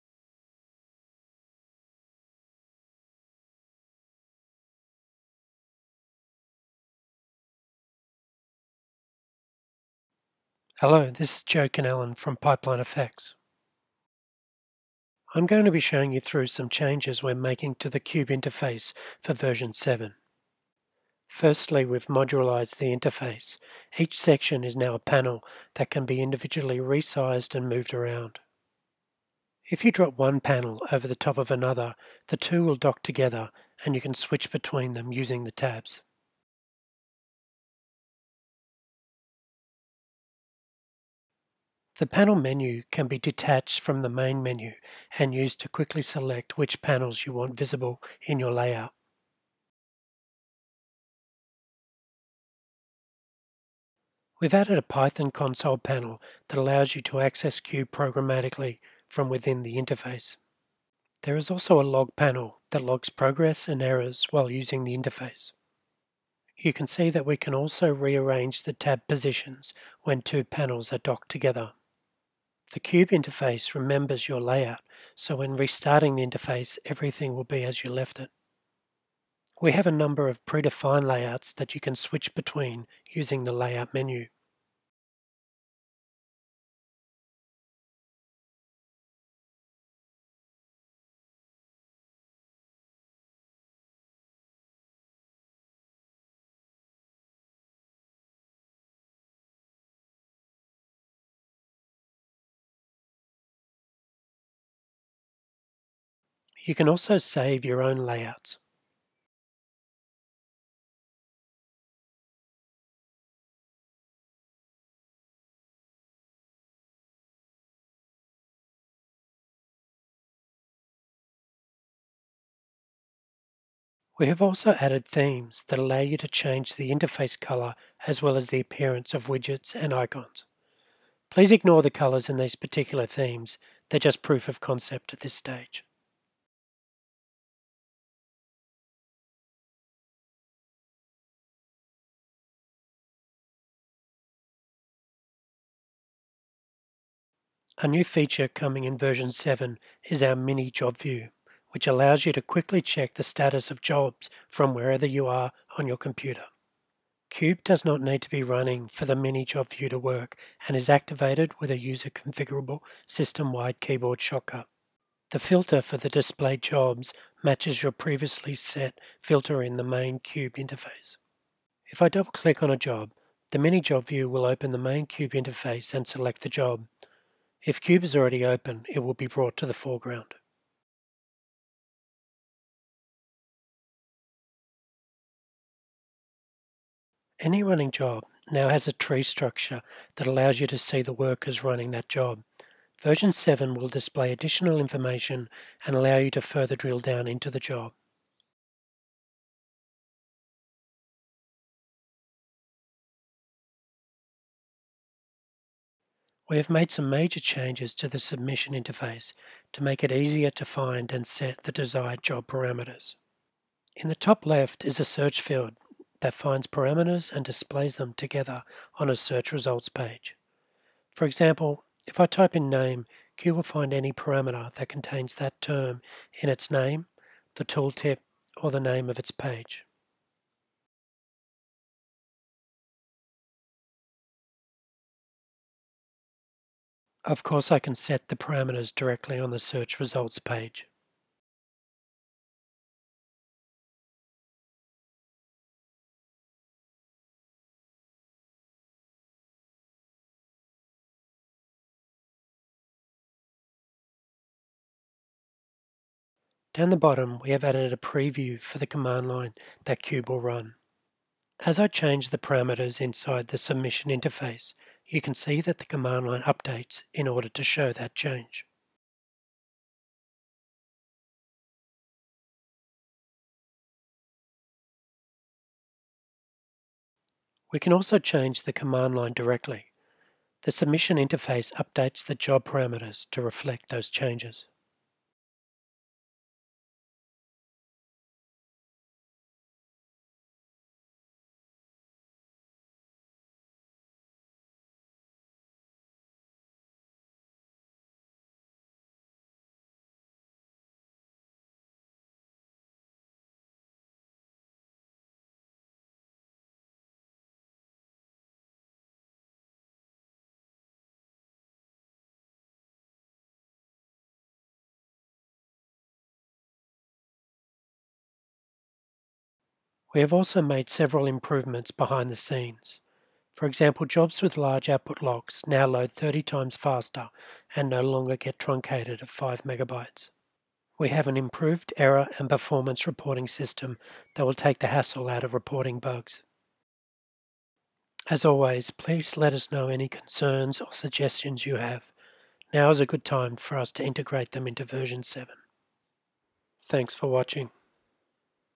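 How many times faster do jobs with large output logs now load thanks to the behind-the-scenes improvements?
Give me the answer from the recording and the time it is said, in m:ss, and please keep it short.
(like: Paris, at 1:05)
30, at 5:26.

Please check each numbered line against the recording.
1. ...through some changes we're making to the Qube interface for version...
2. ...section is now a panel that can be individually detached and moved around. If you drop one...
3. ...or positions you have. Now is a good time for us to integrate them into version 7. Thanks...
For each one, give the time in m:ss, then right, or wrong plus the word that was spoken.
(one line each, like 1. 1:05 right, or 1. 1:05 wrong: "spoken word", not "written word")
1. 0:16 right
2. 0:24 wrong: "resized", not "detached"
3. 5:40 wrong: "suggestions", not "positions".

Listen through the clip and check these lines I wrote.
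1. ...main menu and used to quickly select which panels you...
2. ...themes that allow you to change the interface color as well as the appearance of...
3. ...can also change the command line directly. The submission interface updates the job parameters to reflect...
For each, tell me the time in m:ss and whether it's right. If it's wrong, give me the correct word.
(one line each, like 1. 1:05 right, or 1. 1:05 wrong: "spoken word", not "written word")
1. 0:44 right
2. 2:05 right
3. 4:37 right.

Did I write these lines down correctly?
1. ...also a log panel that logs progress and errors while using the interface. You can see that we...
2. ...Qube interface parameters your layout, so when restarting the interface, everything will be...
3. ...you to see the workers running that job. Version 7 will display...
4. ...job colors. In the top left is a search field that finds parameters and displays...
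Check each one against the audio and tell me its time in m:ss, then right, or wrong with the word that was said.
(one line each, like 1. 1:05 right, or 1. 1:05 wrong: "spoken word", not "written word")
1. 1:01 right
2. 1:12 wrong: "remembers", not "parameters"
3. 3:10 right
4. 3:32 wrong: "parameters", not "colors".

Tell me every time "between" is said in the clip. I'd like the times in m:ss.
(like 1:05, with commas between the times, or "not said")
0:34, 1:22.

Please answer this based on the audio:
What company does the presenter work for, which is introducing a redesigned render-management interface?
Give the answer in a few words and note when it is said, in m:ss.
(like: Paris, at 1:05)
PipelineFX, at 0:12.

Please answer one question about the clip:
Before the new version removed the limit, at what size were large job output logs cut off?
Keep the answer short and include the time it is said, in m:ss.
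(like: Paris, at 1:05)
5 megabytes, at 5:29.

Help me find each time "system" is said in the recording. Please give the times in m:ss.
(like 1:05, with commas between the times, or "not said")
2:43, 5:33.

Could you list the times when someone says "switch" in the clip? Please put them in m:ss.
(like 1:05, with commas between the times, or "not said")
0:34, 1:21.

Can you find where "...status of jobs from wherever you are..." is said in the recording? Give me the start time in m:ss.
2:33.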